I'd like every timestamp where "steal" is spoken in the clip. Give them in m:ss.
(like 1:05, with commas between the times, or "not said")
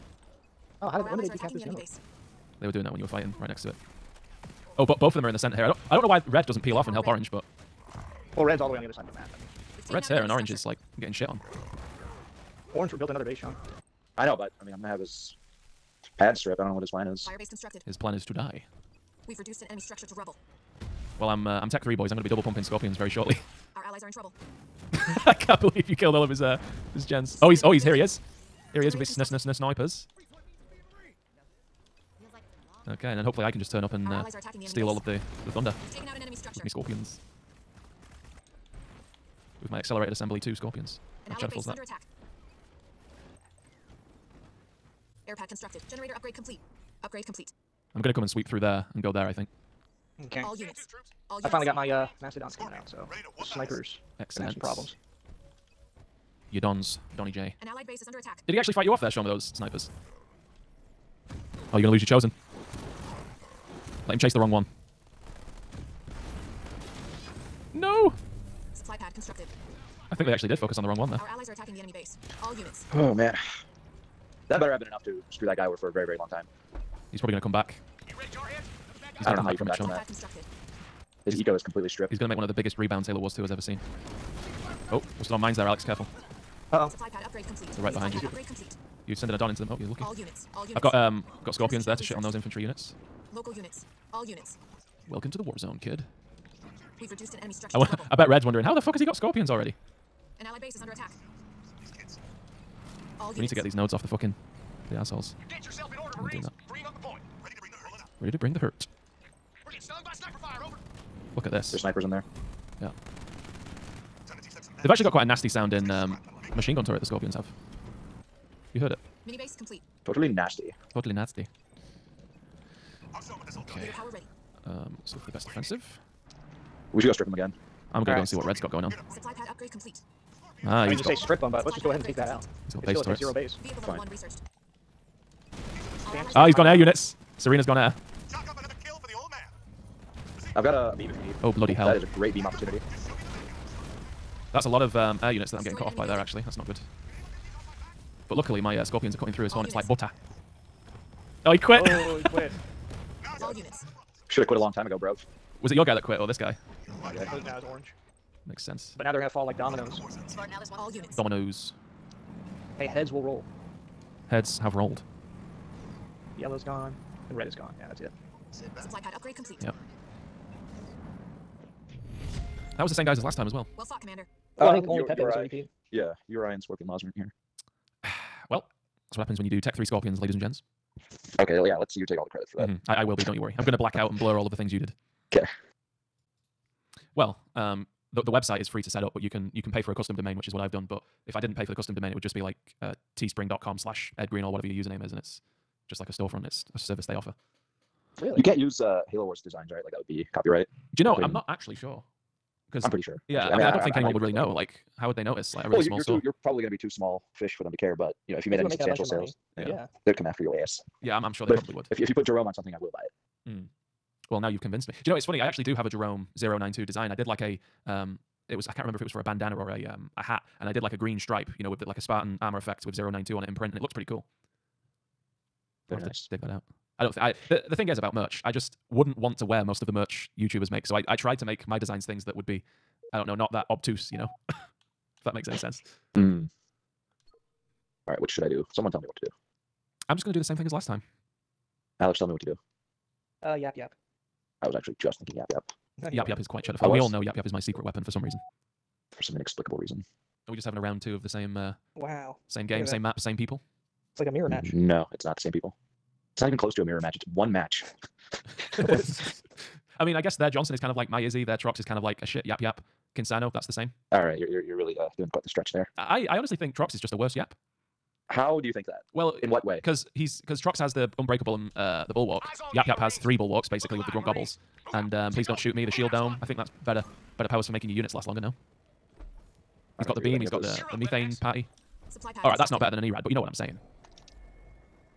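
0:34.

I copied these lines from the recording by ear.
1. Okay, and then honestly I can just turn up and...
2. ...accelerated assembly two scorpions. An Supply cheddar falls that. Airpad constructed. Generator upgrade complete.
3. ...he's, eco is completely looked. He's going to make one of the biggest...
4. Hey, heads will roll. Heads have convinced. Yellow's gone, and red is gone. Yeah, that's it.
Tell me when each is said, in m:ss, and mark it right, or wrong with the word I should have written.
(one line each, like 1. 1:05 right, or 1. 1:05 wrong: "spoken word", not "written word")
1. 0:32 wrong: "hopefully", not "honestly"
2. 0:39 wrong: "How", not "Supply"
3. 1:21 wrong: "stripped", not "looked"
4. 2:42 wrong: "rolled", not "convinced".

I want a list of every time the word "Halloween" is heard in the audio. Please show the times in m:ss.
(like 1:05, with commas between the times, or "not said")
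not said.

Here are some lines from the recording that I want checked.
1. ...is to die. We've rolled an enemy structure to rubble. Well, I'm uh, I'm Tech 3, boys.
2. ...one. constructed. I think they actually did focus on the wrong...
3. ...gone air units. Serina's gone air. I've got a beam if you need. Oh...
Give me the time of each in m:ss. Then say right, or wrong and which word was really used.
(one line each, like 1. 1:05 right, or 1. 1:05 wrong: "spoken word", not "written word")
1. 0:18 wrong: "reduced", not "rolled"
2. 1:04 right
3. 2:16 right.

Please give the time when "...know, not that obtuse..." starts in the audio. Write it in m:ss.
3:53.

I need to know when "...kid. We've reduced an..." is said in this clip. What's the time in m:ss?
1:35.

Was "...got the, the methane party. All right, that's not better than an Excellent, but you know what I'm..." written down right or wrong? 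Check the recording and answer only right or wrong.
wrong.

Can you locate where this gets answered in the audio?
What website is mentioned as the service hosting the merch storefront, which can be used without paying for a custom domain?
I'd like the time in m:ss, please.
3:13.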